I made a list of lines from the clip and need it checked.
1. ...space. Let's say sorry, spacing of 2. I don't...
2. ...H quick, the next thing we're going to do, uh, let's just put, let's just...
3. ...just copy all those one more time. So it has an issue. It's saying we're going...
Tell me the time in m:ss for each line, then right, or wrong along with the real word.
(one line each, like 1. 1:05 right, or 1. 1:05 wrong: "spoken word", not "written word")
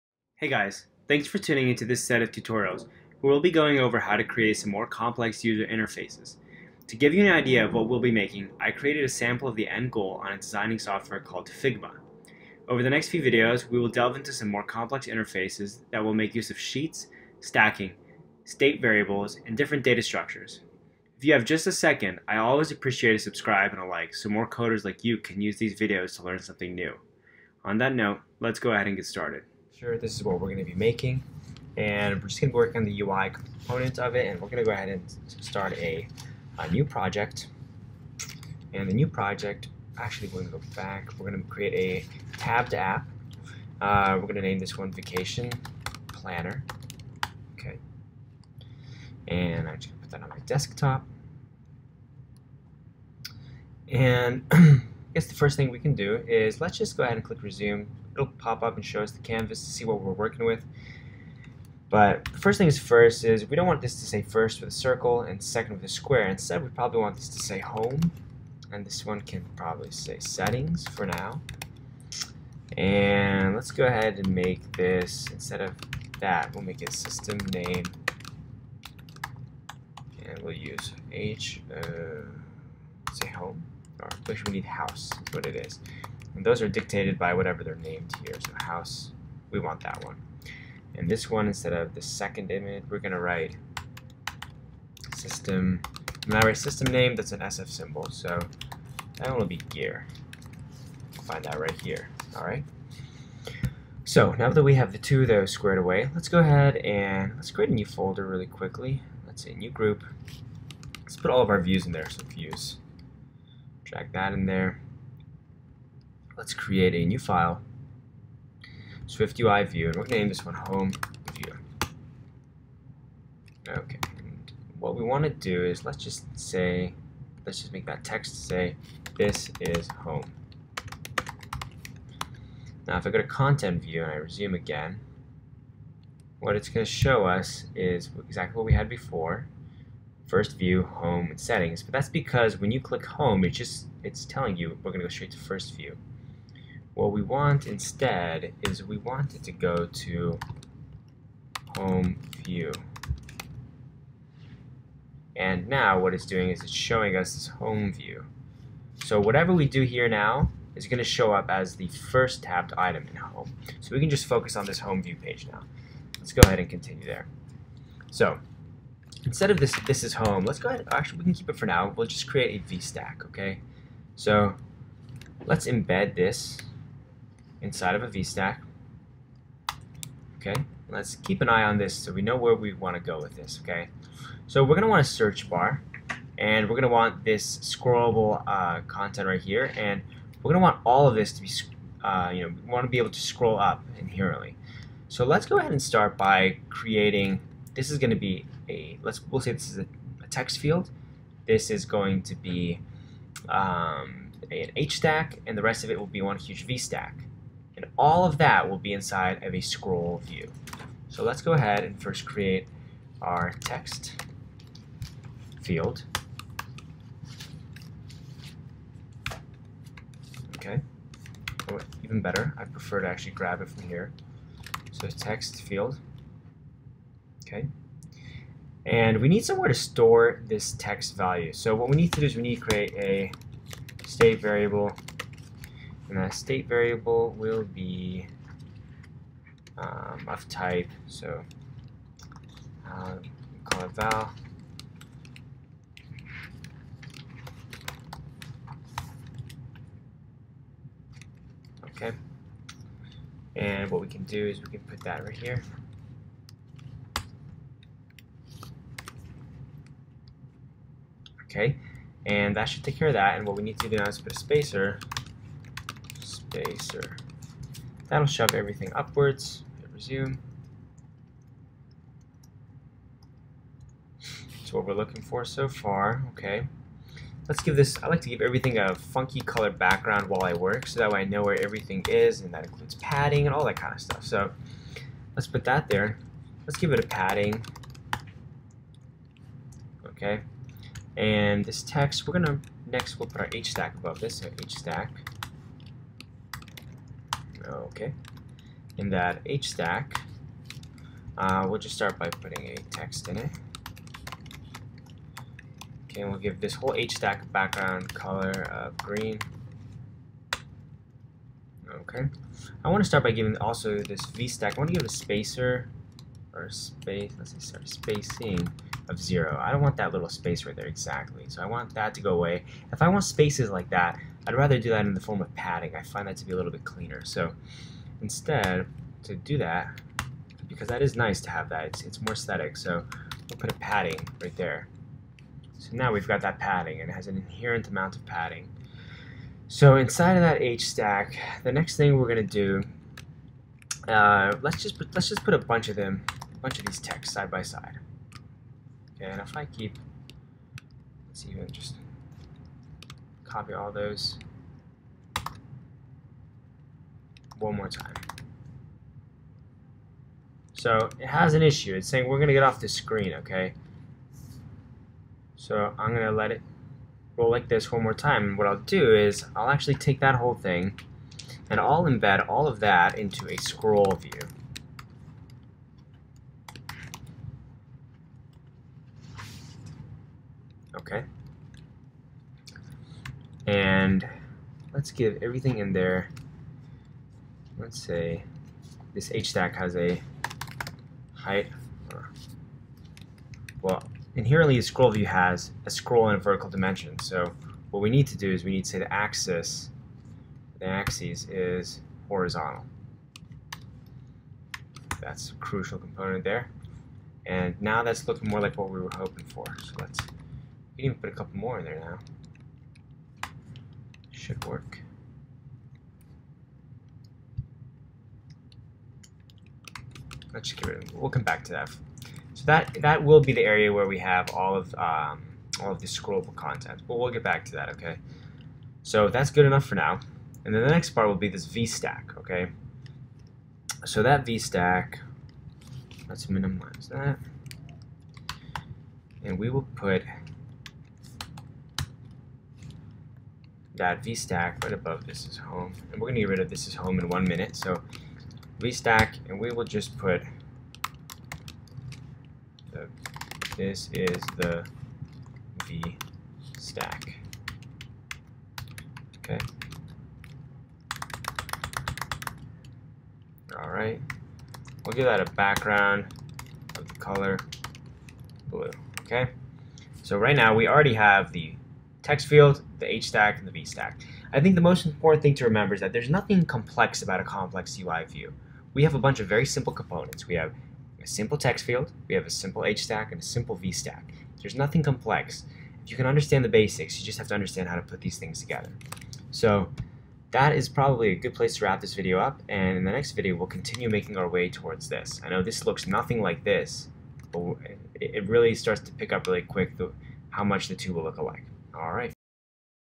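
1. 5:16 wrong: "0", not "2"
2. 5:40 wrong: "stack", not "quick"
3. 5:51 right.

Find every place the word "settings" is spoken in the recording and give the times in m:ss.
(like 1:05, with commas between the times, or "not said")
1:10, 2:21.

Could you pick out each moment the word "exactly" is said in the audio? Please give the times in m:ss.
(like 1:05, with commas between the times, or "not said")
2:18, 5:20.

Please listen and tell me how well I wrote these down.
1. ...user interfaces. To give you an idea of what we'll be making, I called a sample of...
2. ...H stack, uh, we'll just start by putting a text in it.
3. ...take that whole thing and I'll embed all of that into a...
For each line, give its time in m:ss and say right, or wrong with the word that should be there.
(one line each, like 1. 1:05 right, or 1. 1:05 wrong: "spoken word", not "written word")
1. 0:05 wrong: "created", not "called"
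2. 4:59 right
3. 6:09 right.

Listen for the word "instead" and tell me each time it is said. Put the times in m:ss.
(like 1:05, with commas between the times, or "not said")
1:06, 1:15, 1:31, 2:27, 2:49, 5:28.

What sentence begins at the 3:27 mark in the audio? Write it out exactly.
And all of that will be inside of a scroll view.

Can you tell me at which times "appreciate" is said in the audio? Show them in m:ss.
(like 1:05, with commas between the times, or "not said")
0:22.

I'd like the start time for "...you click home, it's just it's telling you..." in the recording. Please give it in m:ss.
2:22.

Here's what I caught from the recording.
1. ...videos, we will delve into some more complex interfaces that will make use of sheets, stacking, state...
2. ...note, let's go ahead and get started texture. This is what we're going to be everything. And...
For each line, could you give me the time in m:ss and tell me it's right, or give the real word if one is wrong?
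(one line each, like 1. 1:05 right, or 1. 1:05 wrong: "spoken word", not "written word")
1. 0:13 right
2. 0:27 wrong: "making", not "everything".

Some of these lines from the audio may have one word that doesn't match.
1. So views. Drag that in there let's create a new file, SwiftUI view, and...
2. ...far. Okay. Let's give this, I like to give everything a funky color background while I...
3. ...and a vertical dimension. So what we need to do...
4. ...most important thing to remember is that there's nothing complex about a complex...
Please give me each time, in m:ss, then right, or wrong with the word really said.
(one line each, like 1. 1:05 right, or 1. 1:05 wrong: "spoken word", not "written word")
1. 1:52 right
2. 4:35 right
3. 6:36 right
4. 7:54 right.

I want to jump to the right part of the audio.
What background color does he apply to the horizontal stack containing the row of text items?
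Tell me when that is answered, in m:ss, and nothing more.
5:08.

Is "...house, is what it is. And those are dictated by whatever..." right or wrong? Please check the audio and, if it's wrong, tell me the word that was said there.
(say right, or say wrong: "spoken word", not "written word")
right.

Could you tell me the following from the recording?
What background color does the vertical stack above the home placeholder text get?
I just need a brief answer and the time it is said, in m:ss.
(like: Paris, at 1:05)
blue, at 7:48.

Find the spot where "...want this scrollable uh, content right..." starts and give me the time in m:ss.
3:06.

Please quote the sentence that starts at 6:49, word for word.
So let's we can even put a couple more in there now.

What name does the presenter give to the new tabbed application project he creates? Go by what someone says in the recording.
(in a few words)
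Vacation Planner.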